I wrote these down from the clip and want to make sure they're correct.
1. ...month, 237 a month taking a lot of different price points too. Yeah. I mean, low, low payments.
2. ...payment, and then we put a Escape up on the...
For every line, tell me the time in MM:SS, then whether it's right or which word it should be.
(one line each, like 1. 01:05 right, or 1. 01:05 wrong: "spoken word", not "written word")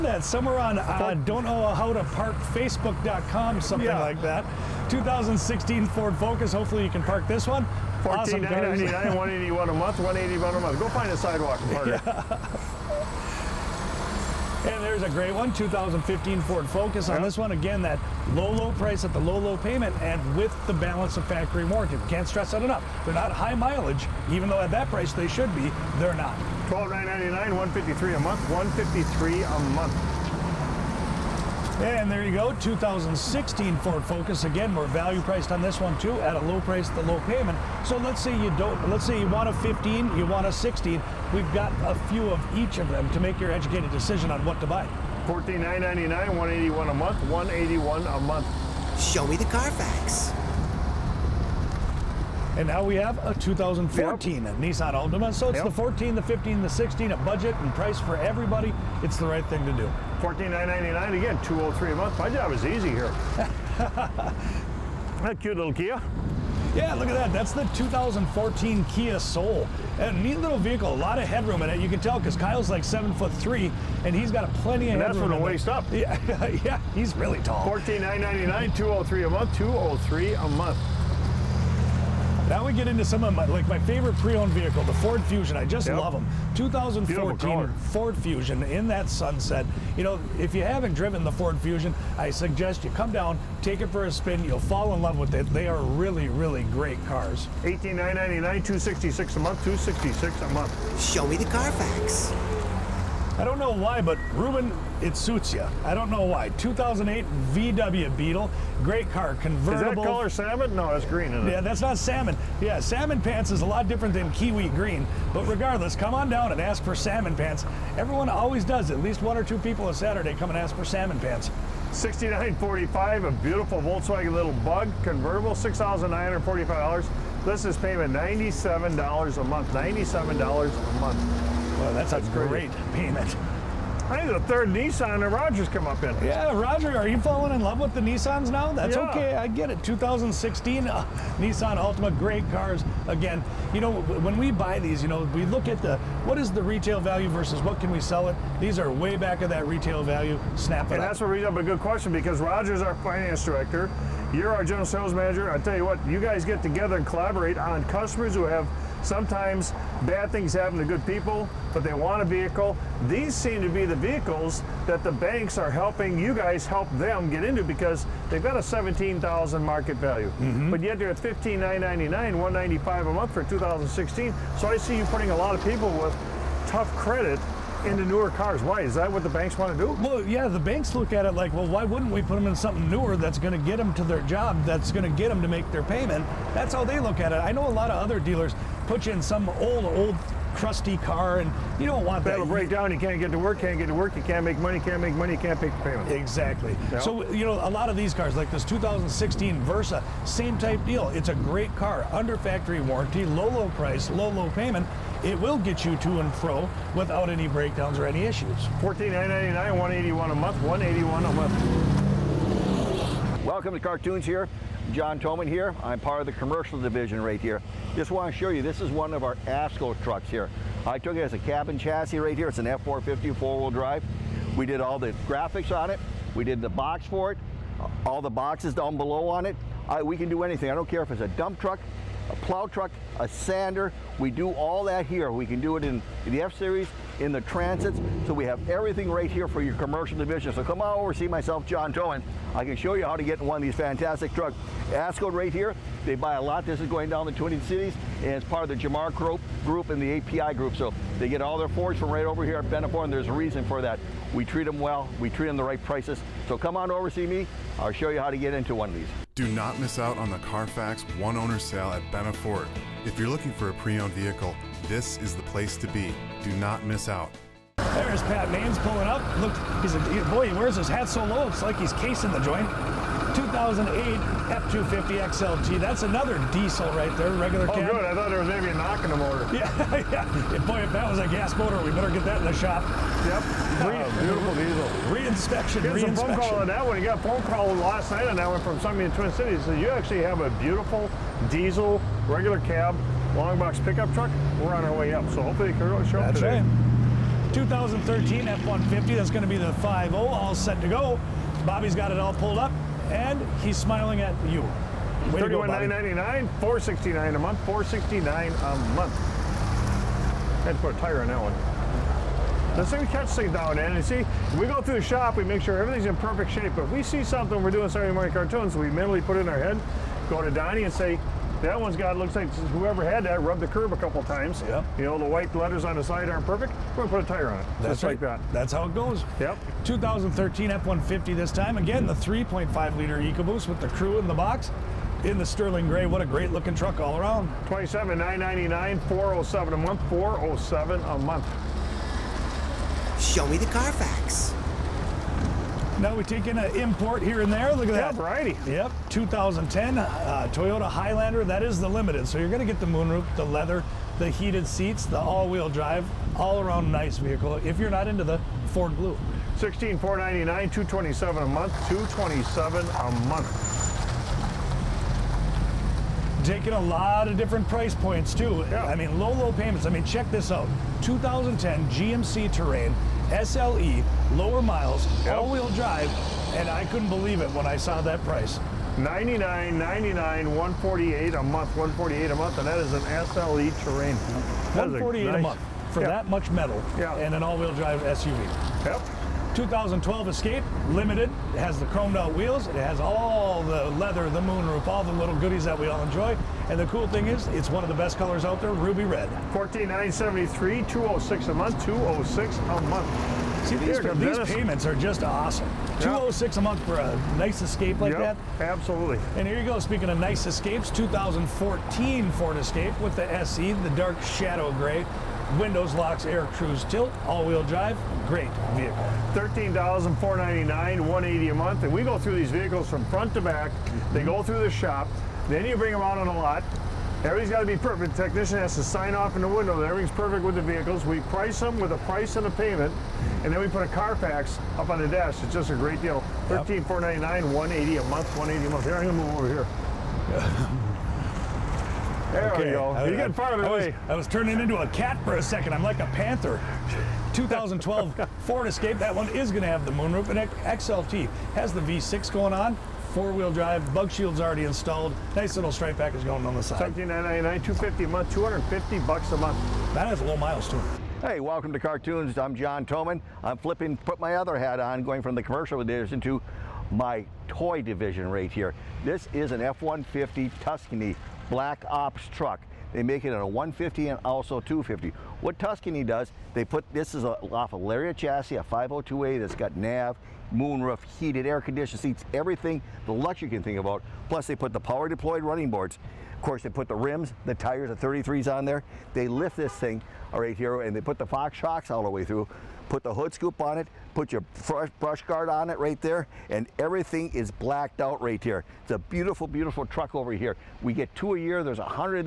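1. 06:01 wrong: "227", not "237"
2. 07:12 wrong: "Carfax", not "Escape".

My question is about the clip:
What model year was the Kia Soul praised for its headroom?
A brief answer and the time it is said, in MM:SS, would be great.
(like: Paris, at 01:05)
2014, at 01:07.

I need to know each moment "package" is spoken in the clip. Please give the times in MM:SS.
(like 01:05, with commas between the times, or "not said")
07:35.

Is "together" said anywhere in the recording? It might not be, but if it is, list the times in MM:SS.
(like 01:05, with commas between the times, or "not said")
02:36.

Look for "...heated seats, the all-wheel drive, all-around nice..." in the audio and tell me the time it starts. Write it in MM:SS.
05:54.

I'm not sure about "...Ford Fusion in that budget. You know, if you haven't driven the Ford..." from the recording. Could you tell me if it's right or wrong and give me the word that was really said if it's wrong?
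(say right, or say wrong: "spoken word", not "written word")
wrong: "sunset", not "budget".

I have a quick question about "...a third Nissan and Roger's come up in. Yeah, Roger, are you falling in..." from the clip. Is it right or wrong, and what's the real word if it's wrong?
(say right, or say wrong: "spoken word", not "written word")
right.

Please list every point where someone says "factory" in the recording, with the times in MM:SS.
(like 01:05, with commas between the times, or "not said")
00:21, 03:22.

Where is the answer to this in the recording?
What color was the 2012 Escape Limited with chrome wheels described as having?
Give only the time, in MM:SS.
06:38.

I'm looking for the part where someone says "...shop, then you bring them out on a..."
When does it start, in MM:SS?
07:04.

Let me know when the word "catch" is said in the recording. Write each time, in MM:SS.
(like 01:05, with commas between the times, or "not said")
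05:13.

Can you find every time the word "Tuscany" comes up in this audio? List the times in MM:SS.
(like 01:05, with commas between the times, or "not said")
07:50, 07:55.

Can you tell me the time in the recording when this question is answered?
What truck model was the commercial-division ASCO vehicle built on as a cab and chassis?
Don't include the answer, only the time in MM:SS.
03:42.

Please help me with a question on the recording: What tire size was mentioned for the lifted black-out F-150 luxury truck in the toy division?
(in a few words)
33s.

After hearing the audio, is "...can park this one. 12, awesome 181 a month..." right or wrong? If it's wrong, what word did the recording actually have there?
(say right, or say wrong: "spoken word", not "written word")
wrong: "14", not "12".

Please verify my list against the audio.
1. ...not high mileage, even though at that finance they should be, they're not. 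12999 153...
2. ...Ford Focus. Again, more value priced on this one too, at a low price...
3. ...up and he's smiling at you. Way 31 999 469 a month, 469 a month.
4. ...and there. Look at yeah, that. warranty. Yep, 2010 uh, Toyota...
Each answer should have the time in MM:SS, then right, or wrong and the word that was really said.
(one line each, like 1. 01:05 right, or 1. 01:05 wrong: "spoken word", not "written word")
1. 00:23 wrong: "price", not "finance"
2. 00:33 right
3. 05:02 right
4. 05:47 wrong: "variety", not "warranty".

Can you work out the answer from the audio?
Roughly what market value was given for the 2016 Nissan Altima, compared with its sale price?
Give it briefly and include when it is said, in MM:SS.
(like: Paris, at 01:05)
17,000, at 02:48.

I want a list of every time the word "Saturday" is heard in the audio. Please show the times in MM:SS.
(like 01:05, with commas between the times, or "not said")
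01:59, 05:17.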